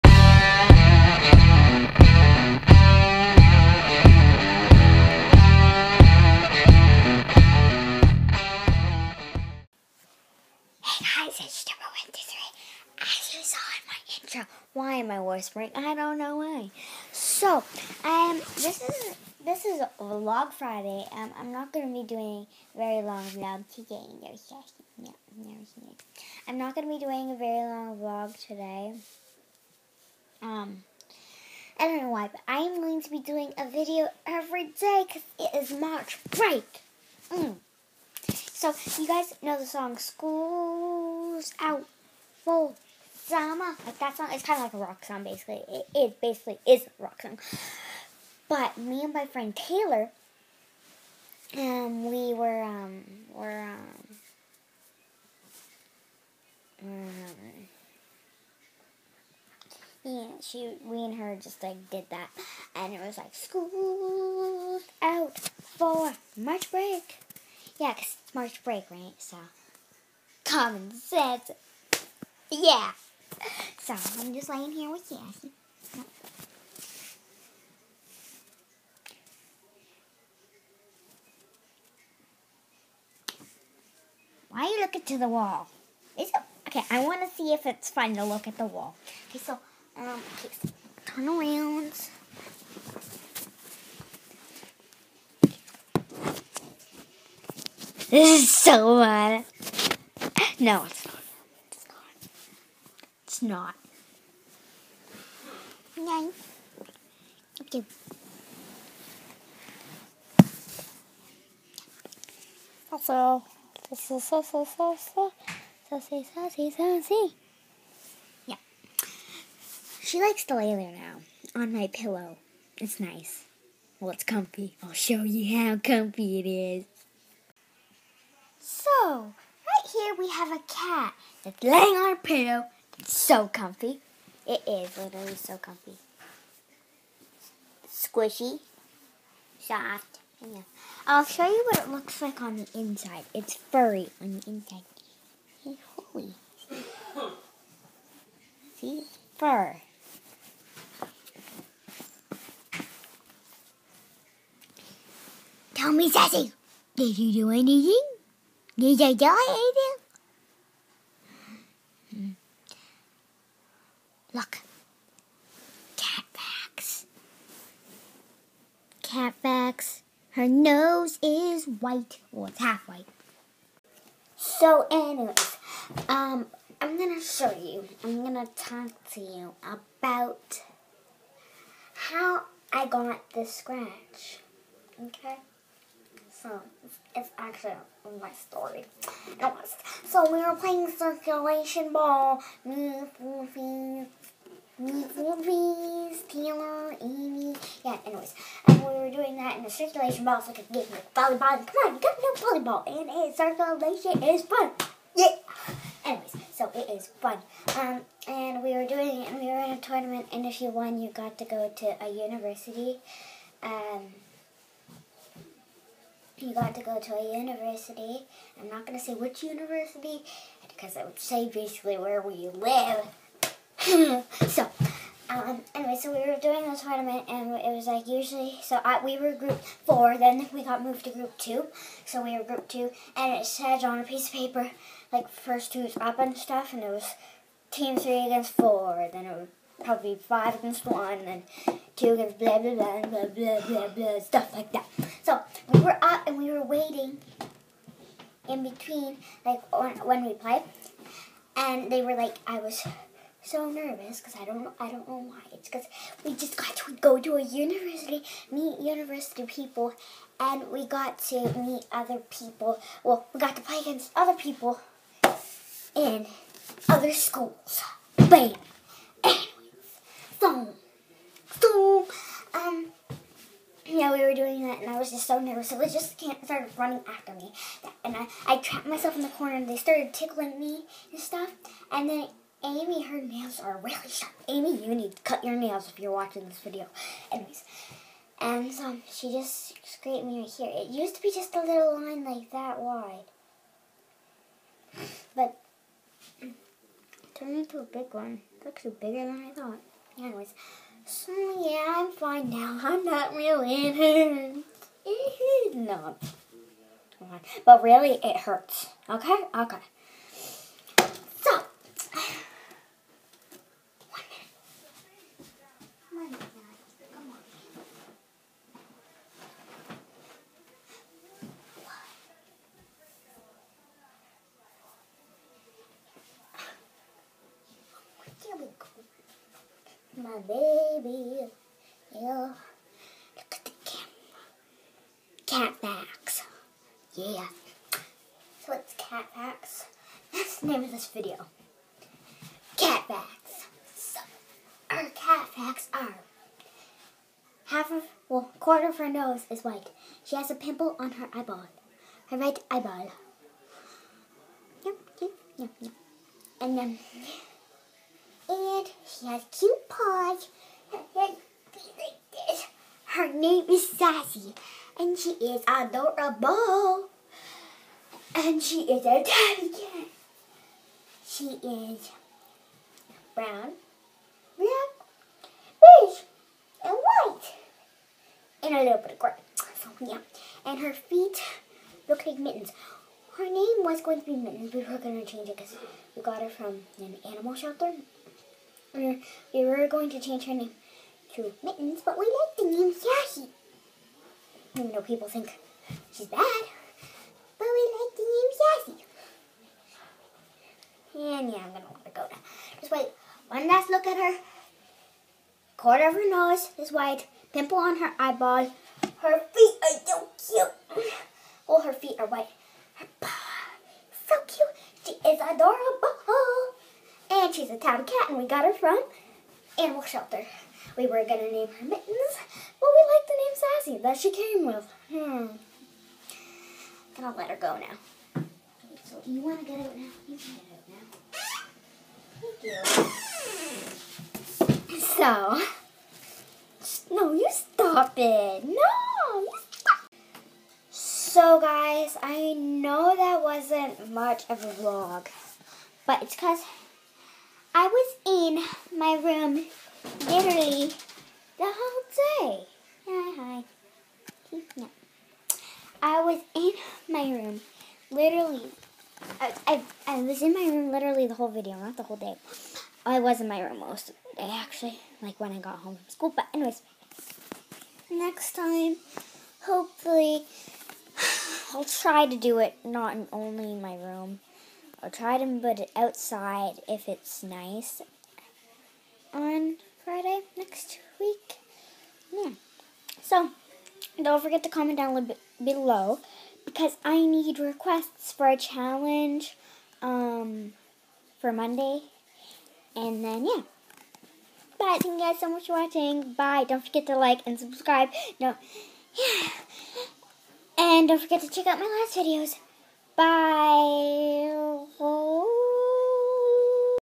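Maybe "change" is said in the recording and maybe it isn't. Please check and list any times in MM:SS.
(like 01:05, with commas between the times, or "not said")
06:25, 06:30.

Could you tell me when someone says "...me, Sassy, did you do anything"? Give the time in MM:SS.
02:35.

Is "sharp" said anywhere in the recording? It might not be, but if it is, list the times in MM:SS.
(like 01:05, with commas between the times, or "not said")
04:44.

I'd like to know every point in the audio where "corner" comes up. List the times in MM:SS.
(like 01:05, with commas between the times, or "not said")
04:39, 06:45.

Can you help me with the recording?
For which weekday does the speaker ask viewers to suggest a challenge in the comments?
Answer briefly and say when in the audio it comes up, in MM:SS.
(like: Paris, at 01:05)
Monday, at 08:11.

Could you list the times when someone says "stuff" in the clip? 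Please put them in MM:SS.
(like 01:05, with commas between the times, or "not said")
03:56, 04:04, 04:41.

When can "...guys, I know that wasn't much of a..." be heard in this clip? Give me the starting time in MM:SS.
07:21.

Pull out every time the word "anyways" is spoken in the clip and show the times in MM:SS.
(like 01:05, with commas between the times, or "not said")
02:54, 03:09, 03:18, 03:26, 03:45, 04:47, 05:00, 07:46.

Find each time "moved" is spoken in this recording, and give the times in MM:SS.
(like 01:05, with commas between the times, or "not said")
03:50.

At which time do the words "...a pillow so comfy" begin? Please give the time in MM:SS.
02:12.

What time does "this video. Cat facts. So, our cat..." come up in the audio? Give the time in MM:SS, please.
05:41.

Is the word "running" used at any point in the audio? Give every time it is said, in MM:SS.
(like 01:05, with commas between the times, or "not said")
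04:36.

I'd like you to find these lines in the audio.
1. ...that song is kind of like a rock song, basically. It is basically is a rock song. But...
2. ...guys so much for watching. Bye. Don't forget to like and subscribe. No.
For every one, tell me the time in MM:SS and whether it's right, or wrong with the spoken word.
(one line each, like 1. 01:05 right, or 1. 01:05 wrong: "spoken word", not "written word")
1. 00:43 right
2. 08:15 right.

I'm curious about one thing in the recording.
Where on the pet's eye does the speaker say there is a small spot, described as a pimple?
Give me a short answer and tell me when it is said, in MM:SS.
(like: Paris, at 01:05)
right eyeball, at 05:52.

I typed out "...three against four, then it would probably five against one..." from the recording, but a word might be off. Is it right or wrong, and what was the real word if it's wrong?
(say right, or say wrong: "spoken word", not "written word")
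right.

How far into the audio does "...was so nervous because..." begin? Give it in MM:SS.
04:12.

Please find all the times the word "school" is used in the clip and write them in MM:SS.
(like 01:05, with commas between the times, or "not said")
00:39, 01:03, 04:27, 07:46.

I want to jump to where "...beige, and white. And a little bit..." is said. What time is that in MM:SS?
06:15.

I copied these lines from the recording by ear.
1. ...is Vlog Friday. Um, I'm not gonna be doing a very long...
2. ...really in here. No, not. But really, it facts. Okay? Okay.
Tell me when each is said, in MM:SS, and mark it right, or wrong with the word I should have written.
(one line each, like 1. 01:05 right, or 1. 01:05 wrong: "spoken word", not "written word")
1. 00:19 right
2. 05:03 wrong: "hurts", not "facts".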